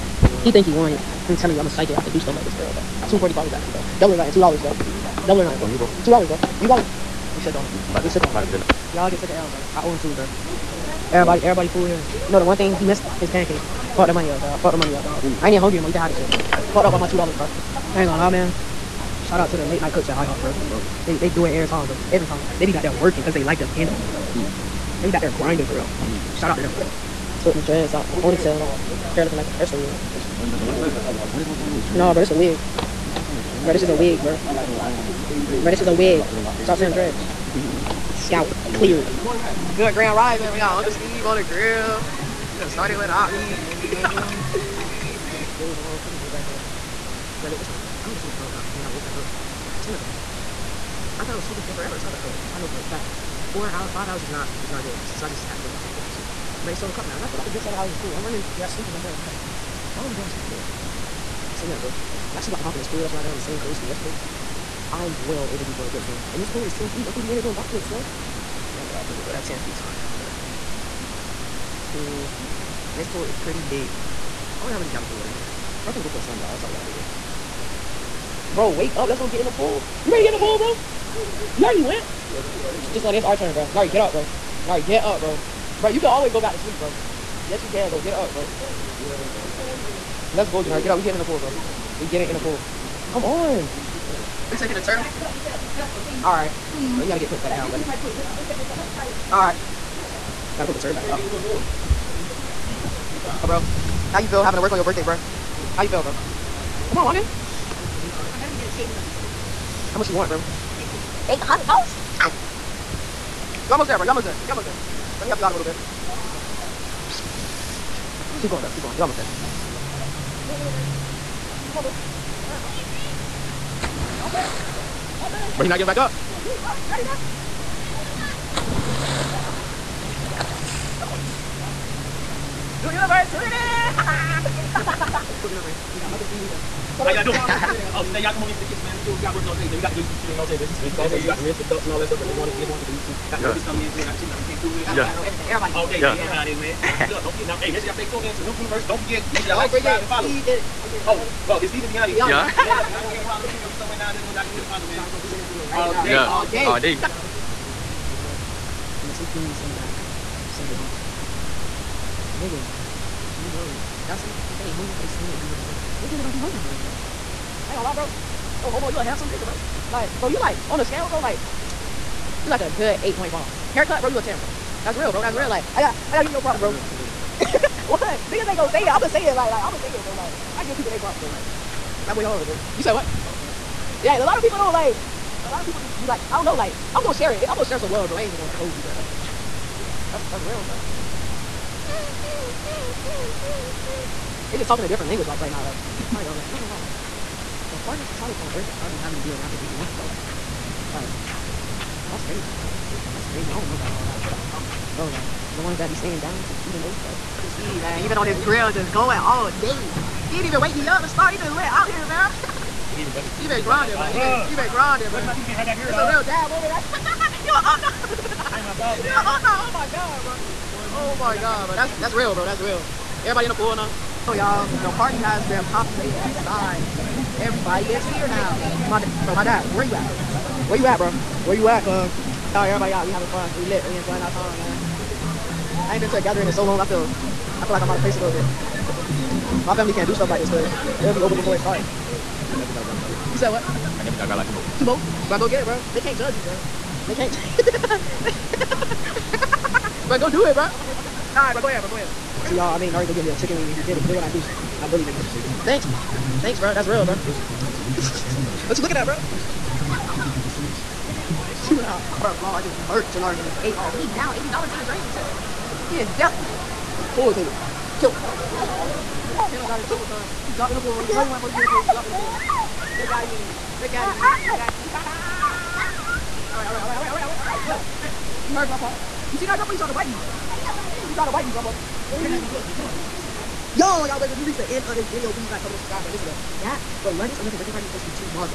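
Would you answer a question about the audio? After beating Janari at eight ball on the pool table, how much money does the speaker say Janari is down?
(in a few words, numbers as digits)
$80.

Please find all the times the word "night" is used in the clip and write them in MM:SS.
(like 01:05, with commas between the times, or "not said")
00:19.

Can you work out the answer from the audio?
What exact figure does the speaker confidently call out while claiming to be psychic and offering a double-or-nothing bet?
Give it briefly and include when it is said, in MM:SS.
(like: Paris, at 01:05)
2:45, at 00:03.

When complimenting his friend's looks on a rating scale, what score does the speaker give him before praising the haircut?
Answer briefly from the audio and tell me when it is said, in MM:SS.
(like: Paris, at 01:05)
8.5, at 02:53.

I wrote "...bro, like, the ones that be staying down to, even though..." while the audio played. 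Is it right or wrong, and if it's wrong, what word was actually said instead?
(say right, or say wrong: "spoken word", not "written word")
right.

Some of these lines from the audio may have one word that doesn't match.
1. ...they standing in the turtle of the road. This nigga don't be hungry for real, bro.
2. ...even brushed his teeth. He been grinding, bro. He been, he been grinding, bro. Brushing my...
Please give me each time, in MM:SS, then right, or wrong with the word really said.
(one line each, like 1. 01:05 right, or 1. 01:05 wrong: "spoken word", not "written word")
1. 02:45 wrong: "middle", not "turtle"
2. 03:33 right.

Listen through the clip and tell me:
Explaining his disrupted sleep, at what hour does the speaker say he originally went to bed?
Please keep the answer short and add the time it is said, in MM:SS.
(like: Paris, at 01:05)
5 o'clock, at 00:48.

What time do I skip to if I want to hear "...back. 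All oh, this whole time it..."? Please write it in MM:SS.
00:30.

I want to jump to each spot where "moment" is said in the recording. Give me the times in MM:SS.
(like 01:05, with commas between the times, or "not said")
03:36.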